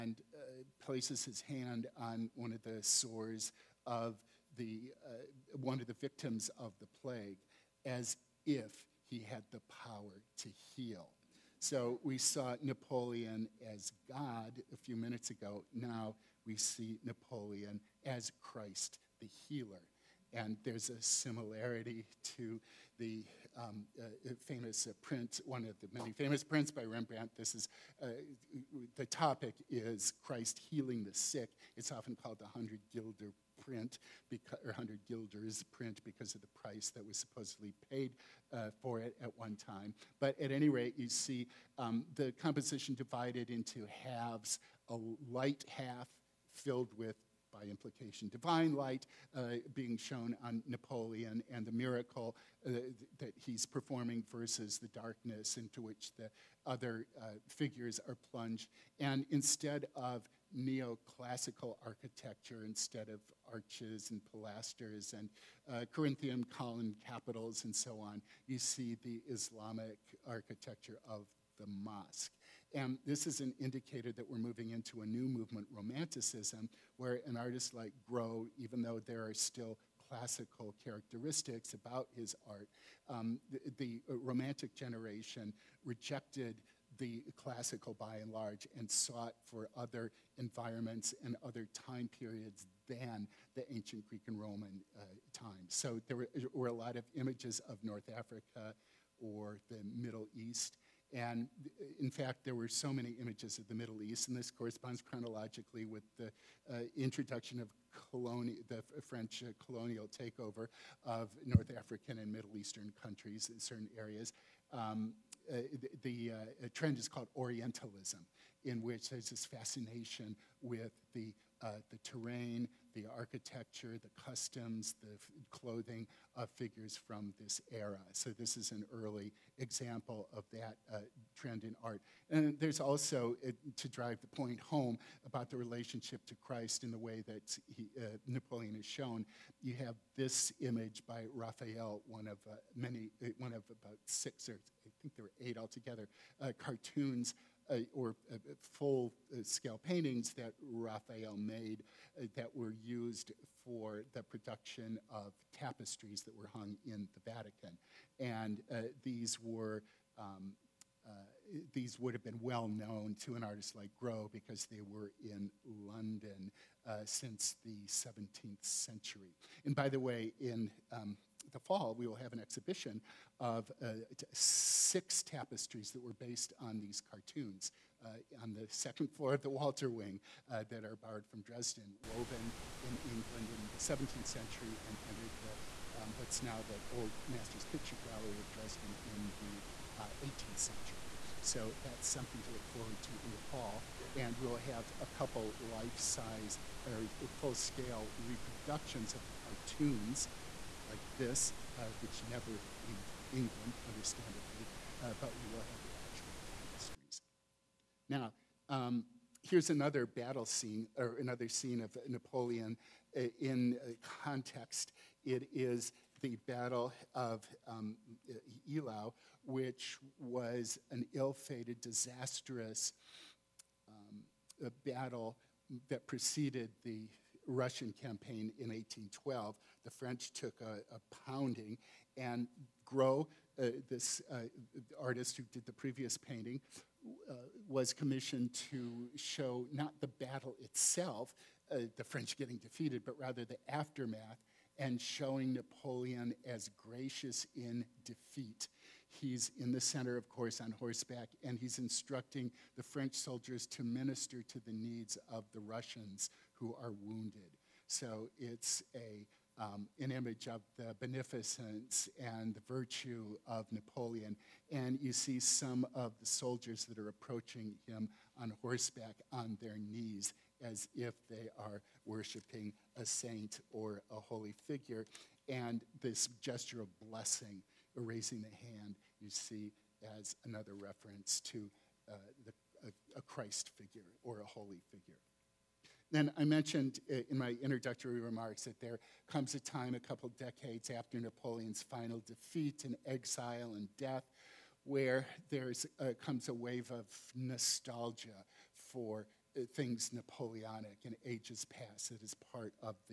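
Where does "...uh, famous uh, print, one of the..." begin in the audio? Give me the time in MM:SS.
00:24.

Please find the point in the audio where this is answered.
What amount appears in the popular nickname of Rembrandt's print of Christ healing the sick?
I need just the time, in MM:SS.
00:34.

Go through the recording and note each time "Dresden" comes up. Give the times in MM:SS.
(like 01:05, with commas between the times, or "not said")
03:01, 03:08.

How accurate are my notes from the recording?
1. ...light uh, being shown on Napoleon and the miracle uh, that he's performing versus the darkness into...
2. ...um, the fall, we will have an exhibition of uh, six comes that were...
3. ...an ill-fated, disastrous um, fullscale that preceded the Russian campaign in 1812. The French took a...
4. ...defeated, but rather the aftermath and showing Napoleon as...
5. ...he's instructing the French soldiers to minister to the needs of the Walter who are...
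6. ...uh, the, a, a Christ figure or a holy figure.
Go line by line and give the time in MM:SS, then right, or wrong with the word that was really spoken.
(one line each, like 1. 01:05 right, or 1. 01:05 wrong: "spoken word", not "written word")
1. 00:48 right
2. 02:50 wrong: "tapestries", not "comes"
3. 03:40 wrong: "battle", not "fullscale"
4. 04:02 right
5. 04:11 wrong: "Russians", not "Walter"
6. 04:42 right.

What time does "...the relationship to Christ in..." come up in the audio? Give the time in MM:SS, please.
02:15.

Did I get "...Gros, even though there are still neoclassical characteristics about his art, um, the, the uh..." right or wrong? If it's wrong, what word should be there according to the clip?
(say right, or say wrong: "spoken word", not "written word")
wrong: "classical", not "neoclassical".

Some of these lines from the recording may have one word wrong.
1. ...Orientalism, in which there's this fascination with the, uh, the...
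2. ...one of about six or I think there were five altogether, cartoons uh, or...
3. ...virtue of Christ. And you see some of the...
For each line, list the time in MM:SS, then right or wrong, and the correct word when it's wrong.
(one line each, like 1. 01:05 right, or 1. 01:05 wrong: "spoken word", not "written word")
1. 01:57 right
2. 02:23 wrong: "eight", not "five"
3. 04:22 wrong: "Napoleon", not "Christ".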